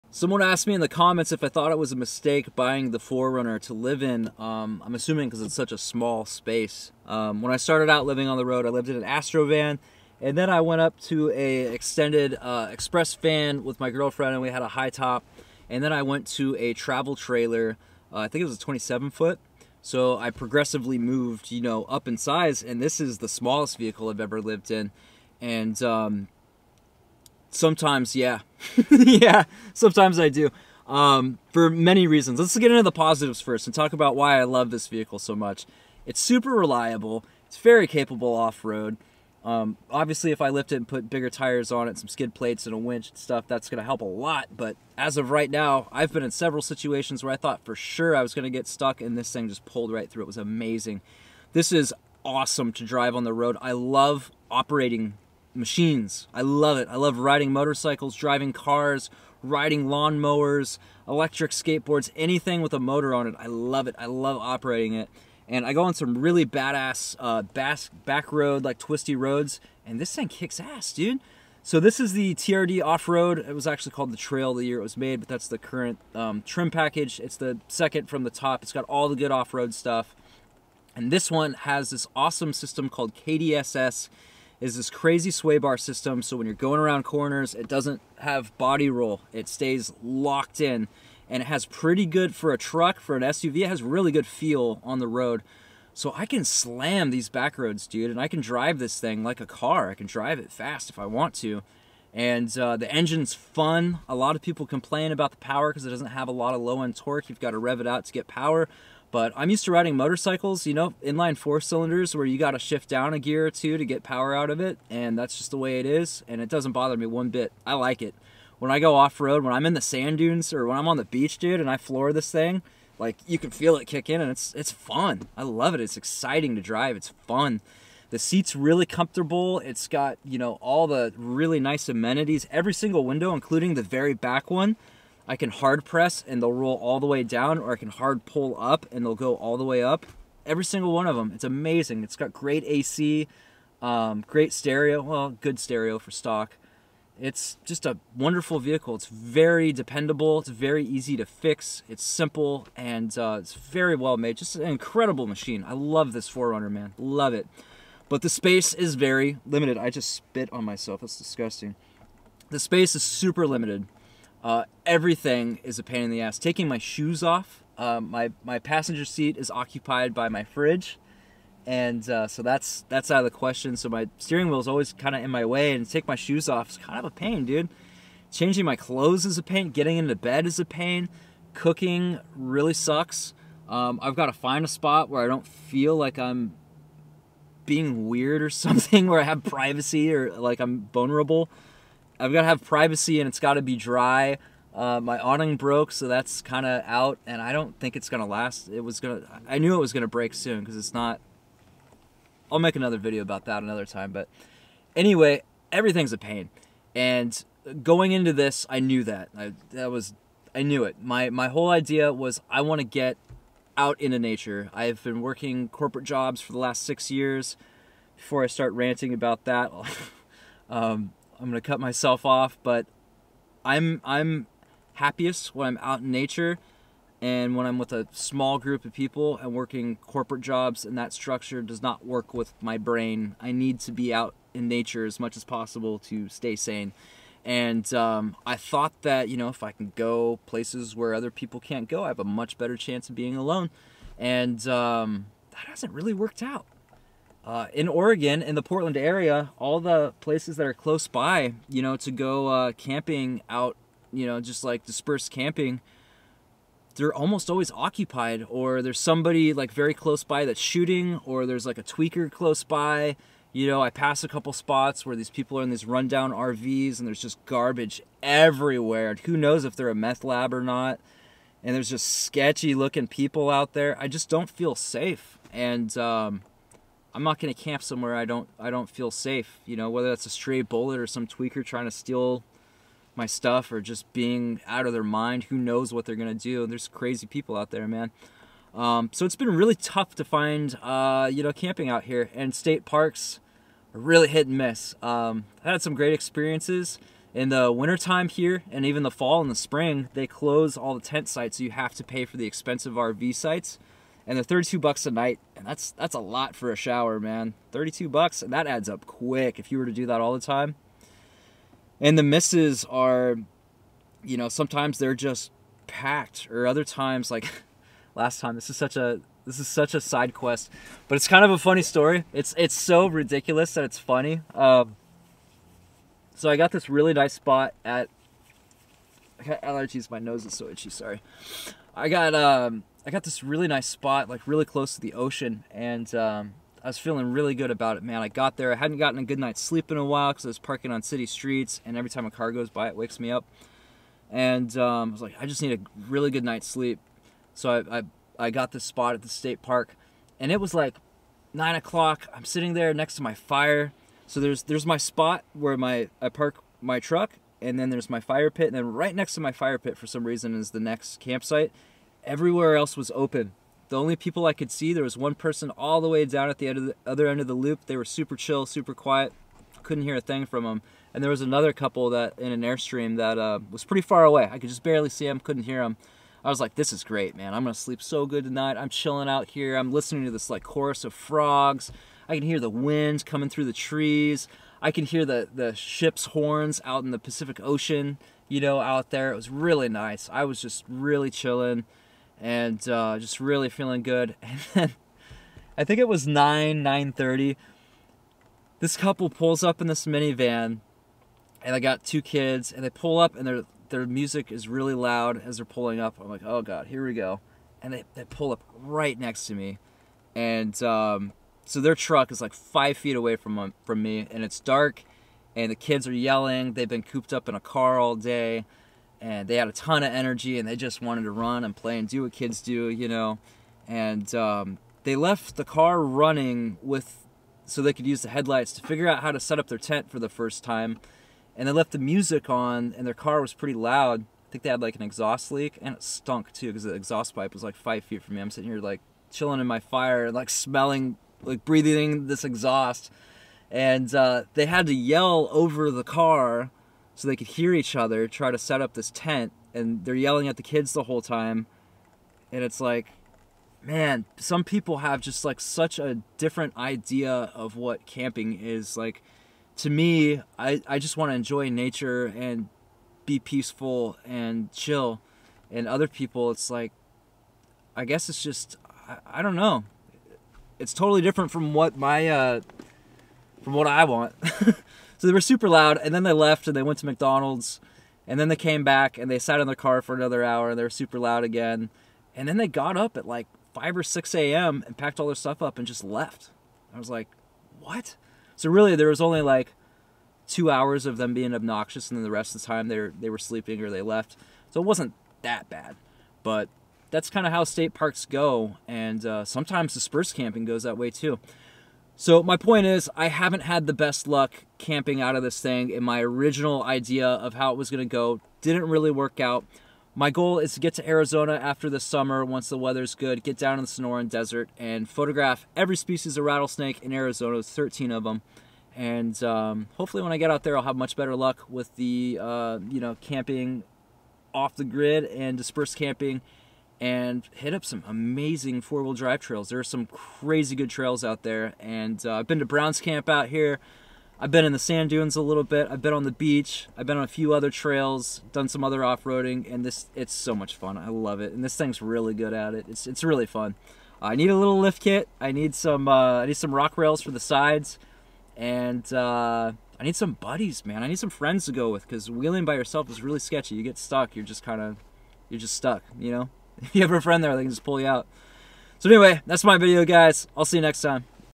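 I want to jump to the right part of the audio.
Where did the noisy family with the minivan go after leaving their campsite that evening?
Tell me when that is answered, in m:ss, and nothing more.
7:57.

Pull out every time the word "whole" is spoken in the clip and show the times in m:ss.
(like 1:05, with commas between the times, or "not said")
3:31, 7:31.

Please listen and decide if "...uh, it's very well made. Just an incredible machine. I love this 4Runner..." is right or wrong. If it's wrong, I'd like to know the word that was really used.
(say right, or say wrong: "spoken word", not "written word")
right.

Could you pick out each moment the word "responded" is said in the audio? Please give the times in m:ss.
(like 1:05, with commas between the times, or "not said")
not said.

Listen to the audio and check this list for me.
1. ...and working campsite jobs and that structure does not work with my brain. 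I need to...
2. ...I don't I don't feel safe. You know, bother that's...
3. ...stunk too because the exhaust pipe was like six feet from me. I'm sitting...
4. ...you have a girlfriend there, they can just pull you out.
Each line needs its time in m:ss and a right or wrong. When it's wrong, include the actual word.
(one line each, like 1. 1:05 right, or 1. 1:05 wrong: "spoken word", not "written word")
1. 3:49 wrong: "corporate", not "campsite"
2. 4:38 wrong: "whether", not "bother"
3. 7:16 wrong: "five", not "six"
4. 9:16 wrong: "friend", not "girlfriend".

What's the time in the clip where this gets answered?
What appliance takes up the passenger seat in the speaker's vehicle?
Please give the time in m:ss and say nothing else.
2:50.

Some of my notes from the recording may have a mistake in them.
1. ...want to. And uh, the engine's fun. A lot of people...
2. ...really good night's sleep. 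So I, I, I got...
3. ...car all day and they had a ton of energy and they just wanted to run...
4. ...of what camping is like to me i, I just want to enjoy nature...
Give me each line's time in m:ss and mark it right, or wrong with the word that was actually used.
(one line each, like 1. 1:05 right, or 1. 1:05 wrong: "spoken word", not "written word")
1. 1:41 right
2. 5:46 right
3. 6:57 right
4. 7:37 right.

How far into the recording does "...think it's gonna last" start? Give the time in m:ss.
3:17.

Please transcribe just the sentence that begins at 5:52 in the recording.
I'm sitting there next to my fire.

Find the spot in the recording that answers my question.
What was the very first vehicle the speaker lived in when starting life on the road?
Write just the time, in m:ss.
0:09.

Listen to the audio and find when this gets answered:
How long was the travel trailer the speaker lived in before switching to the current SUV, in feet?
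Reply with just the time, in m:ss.
0:18.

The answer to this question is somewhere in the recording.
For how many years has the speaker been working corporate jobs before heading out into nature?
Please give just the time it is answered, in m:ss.
3:36.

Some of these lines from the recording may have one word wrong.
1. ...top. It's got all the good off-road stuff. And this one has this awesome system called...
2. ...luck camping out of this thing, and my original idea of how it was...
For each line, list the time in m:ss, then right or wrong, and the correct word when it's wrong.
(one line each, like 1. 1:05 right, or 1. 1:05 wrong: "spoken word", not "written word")
1. 1:18 right
2. 8:24 right.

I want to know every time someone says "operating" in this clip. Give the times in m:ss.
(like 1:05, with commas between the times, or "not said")
0:54, 1:04.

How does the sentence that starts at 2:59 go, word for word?
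Getting into bed is a pain.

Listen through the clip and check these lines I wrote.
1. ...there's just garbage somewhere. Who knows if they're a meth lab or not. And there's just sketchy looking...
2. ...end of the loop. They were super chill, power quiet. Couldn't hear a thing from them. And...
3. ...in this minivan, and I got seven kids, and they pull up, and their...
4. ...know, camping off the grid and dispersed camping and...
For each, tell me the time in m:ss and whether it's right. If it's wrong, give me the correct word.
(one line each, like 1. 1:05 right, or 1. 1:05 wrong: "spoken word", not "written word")
1. 4:27 wrong: "everywhere", not "somewhere"
2. 6:07 wrong: "super", not "power"
3. 6:39 wrong: "two", not "seven"
4. 8:42 right.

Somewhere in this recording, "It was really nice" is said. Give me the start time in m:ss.
6:29.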